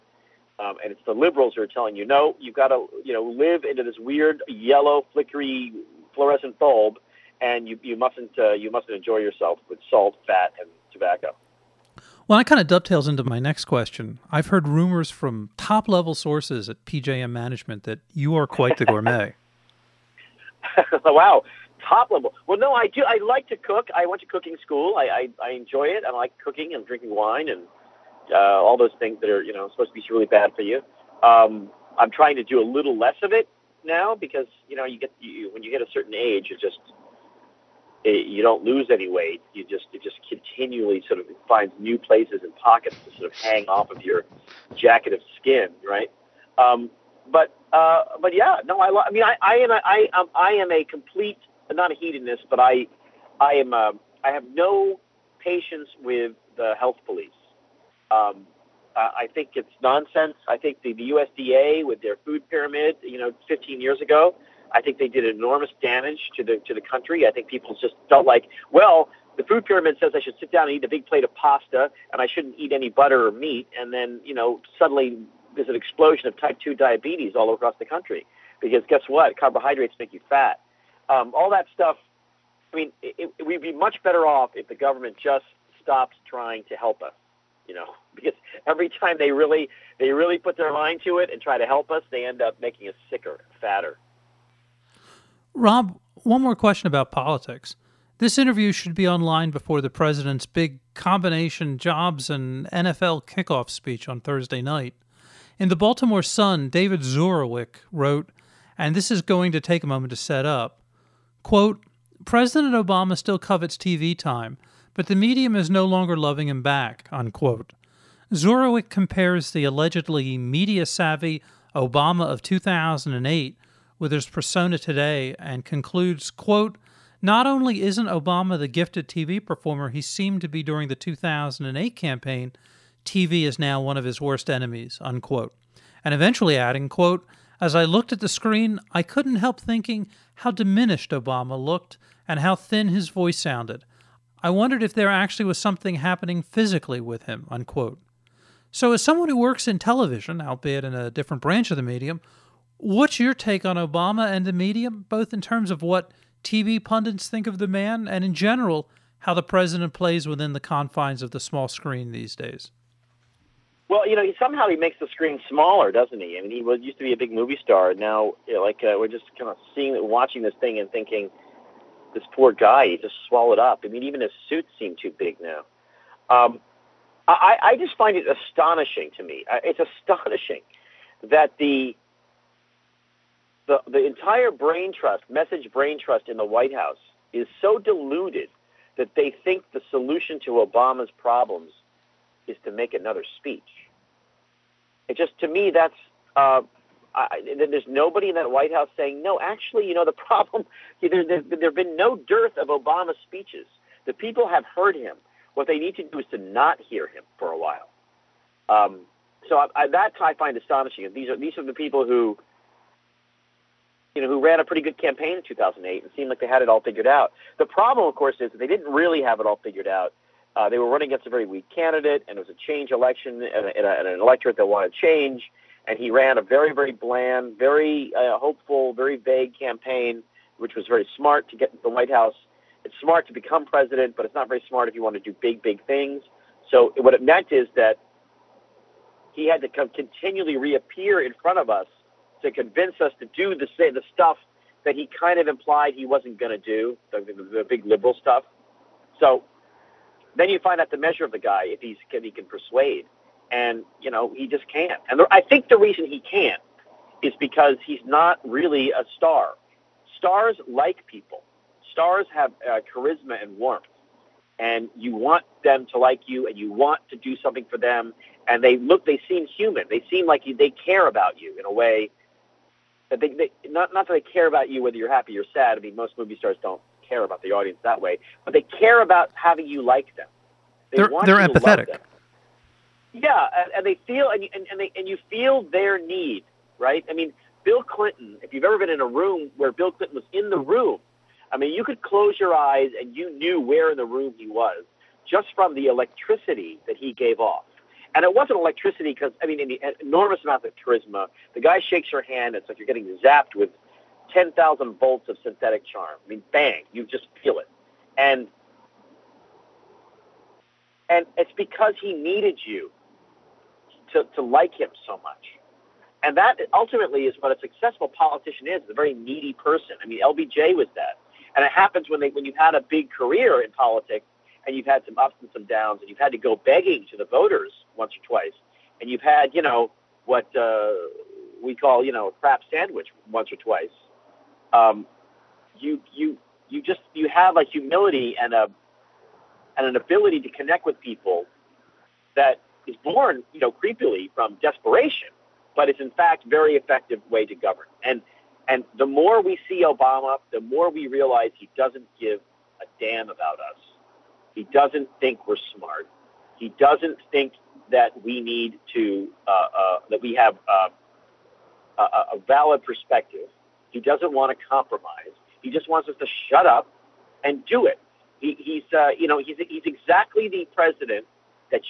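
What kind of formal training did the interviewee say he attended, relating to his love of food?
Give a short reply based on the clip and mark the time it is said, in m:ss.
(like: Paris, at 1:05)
Cooking school, at 0:24.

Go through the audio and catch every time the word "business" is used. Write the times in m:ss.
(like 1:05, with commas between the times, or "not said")
not said.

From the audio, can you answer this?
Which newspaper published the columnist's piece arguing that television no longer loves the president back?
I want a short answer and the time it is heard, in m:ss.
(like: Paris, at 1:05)
The Baltimore Sun, at 1:45.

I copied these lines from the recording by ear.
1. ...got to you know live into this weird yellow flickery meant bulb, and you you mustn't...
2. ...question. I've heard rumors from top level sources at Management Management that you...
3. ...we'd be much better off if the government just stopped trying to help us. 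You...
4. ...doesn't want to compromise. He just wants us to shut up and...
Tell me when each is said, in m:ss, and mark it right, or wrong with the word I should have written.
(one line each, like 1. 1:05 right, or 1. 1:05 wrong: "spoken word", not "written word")
1. 0:02 wrong: "fluorescent", not "meant"
2. 0:13 wrong: "PJM", not "Management"
3. 1:23 right
4. 6:03 right.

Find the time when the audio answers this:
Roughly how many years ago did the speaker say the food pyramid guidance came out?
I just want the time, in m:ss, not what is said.
1:03.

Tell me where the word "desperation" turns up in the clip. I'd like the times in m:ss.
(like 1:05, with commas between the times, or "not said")
5:44.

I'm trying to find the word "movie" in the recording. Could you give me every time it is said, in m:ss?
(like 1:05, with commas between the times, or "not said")
2:47, 4:36.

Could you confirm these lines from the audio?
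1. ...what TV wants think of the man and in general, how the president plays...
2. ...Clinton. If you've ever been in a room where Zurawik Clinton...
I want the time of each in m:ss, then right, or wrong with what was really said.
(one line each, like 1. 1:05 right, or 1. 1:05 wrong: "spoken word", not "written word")
1. 2:35 wrong: "pundits", not "wants"
2. 4:47 wrong: "Bill", not "Zurawik".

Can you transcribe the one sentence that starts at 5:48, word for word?
And and the more we see Obama, the more we realize he doesn't give a damn about us.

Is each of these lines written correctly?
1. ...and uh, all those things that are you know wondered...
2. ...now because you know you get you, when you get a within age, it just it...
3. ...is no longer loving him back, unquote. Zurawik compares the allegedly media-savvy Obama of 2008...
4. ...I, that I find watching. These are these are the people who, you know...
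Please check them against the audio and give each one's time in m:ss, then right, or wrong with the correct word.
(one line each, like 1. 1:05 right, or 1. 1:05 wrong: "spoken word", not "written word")
1. 0:27 wrong: "supposed", not "wondered"
2. 0:33 wrong: "certain", not "within"
3. 1:55 right
4. 3:29 wrong: "astonishing", not "watching".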